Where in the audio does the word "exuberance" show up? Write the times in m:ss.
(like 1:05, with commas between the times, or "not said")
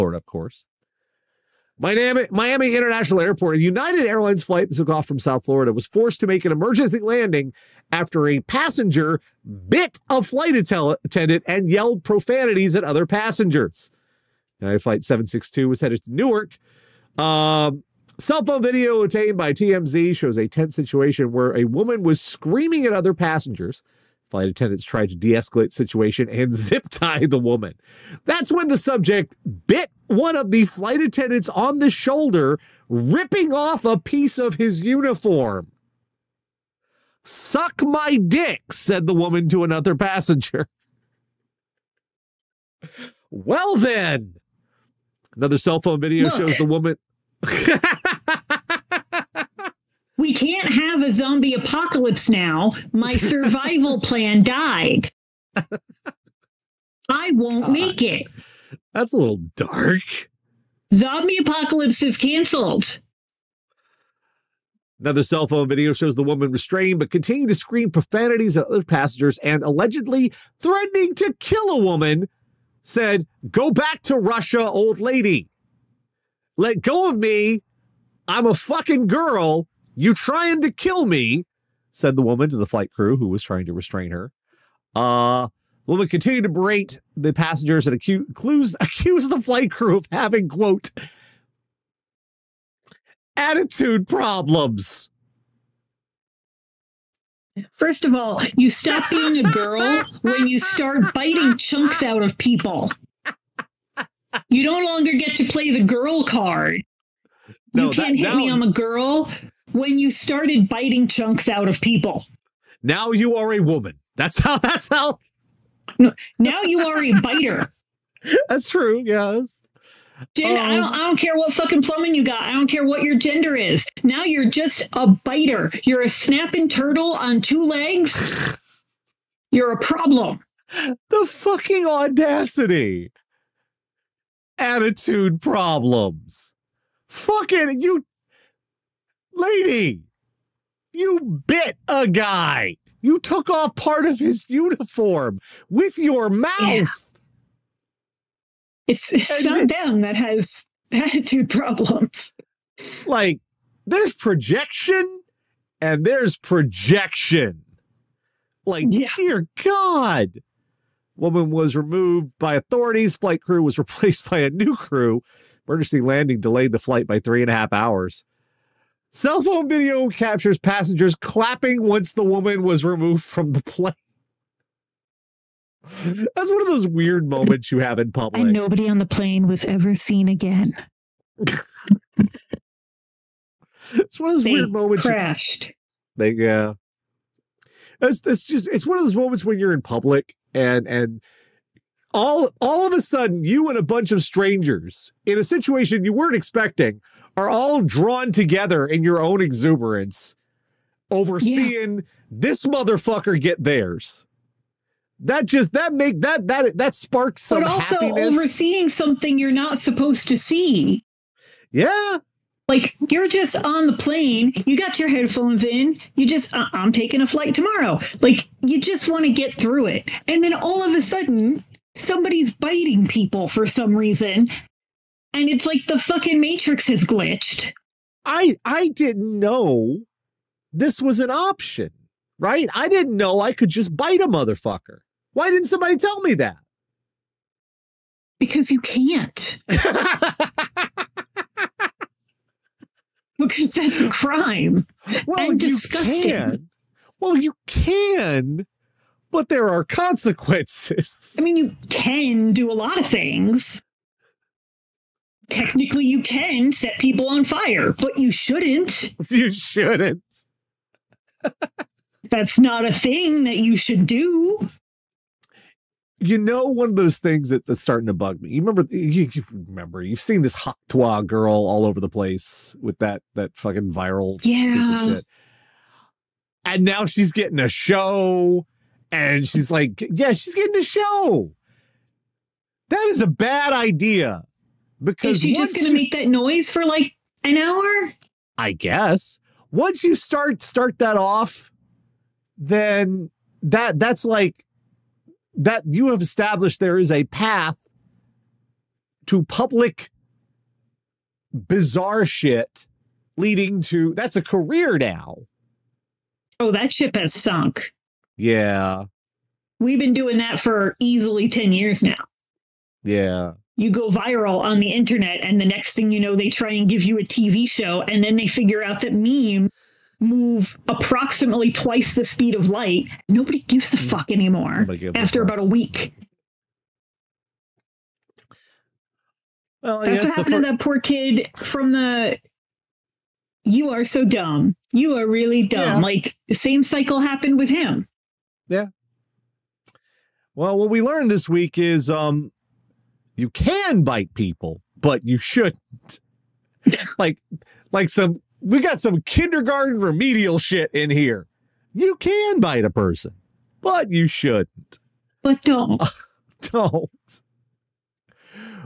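3:19.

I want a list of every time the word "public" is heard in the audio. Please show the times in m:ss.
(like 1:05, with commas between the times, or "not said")
2:58, 3:09, 4:59.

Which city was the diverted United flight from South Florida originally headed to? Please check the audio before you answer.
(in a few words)
Newark.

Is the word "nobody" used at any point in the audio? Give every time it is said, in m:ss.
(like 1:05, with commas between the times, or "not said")
2:58, 5:23.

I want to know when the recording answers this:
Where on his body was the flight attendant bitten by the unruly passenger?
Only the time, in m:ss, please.
0:31.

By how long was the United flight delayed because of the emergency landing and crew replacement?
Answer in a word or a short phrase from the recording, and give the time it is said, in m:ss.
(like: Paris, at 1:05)
3 and a half hours, at 2:47.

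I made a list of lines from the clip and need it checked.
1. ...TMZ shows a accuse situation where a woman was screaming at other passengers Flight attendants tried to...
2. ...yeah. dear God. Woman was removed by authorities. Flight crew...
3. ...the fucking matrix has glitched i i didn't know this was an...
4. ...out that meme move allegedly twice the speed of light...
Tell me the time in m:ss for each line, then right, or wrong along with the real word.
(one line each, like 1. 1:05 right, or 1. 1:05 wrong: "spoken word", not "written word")
1. 0:19 wrong: "tense", not "accuse"
2. 2:38 right
3. 3:45 right
4. 5:18 wrong: "approximately", not "allegedly".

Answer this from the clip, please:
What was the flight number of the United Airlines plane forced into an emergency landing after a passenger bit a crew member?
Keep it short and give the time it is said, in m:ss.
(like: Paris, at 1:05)
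762, at 0:15.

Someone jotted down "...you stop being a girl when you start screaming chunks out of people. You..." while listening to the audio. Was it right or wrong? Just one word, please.
wrong.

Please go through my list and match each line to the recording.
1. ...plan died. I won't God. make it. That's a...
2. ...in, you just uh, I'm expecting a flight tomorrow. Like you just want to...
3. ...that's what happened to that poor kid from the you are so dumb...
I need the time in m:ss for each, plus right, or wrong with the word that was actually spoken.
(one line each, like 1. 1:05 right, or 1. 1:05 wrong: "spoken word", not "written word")
1. 0:53 right
2. 3:35 wrong: "taking", not "expecting"
3. 5:29 right.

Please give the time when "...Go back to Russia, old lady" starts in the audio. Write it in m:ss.
1:13.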